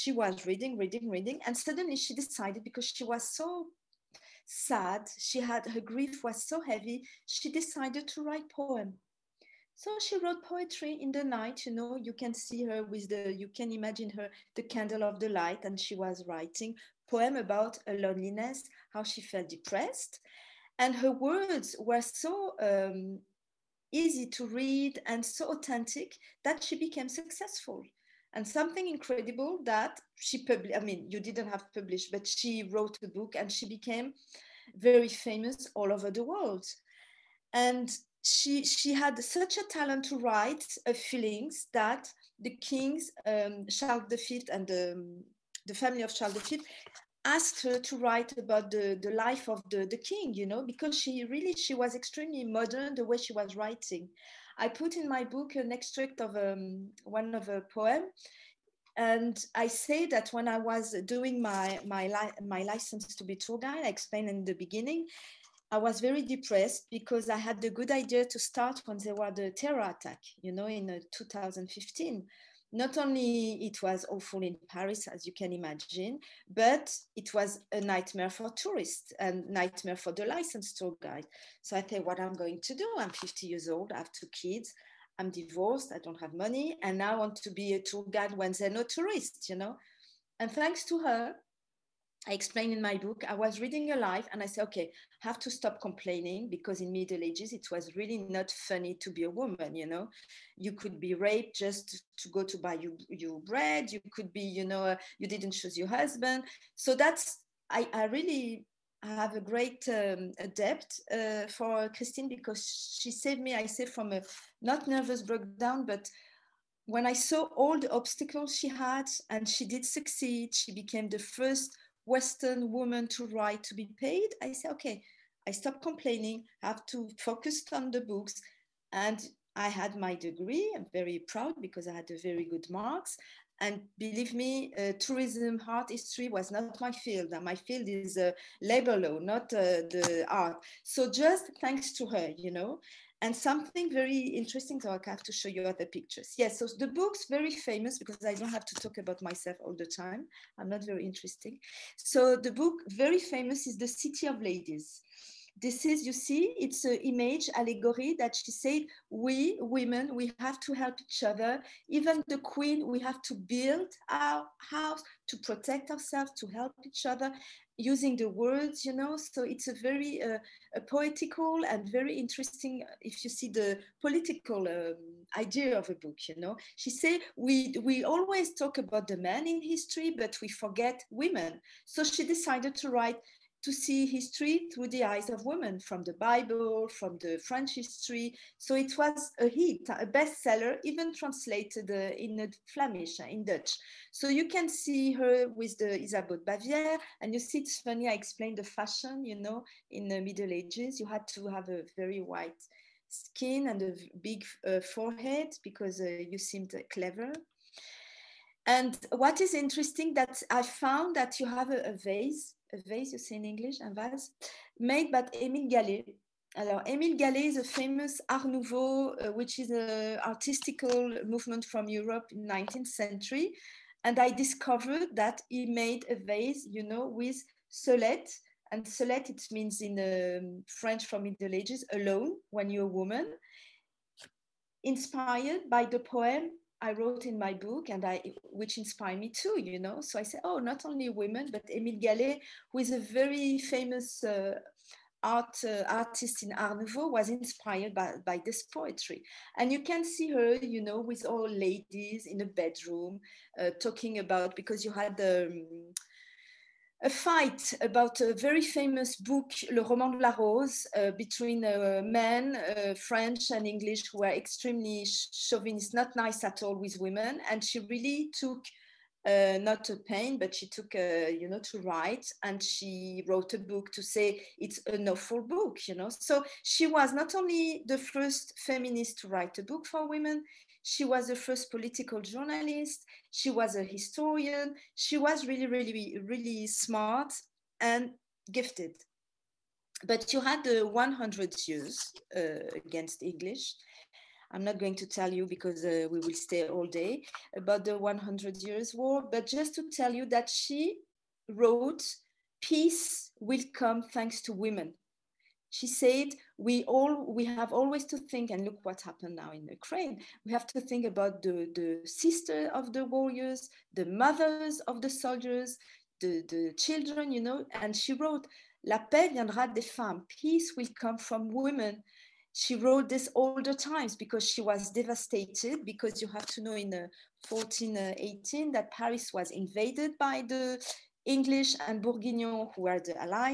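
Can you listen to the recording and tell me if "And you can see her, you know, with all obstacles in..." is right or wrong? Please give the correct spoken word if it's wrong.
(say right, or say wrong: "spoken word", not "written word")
wrong: "ladies", not "obstacles".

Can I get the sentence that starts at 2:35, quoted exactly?
This is, you see, it's an image allegory that she said, we women, we have to help each other.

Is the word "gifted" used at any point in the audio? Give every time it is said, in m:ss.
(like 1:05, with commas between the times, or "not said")
4:48.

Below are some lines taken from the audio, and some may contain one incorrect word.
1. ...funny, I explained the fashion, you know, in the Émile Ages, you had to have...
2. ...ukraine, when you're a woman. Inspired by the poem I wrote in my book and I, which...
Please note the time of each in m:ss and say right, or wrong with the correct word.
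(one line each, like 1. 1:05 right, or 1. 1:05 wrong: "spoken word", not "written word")
1. 3:17 wrong: "Middle", not "Émile"
2. 3:51 wrong: "alone", not "ukraine".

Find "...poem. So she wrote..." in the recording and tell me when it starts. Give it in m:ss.
0:08.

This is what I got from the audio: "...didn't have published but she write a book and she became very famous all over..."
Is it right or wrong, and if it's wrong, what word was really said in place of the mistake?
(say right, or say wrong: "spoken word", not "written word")
wrong: "wrote", not "write".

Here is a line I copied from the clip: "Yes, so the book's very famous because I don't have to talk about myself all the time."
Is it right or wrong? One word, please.
right.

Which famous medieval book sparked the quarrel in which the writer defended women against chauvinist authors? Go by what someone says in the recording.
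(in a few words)
Le Roman de la Rose.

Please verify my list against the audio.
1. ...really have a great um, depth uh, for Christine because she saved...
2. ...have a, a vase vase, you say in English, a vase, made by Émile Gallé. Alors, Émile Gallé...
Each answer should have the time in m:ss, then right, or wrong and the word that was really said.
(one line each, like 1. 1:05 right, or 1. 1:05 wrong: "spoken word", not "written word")
1. 1:48 right
2. 3:31 right.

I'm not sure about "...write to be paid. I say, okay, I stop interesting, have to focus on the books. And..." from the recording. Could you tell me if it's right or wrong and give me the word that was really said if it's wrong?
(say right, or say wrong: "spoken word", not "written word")
wrong: "complaining", not "interesting".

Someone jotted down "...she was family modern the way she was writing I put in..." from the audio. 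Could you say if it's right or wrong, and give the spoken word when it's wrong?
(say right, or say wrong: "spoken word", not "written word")
wrong: "extremely", not "family".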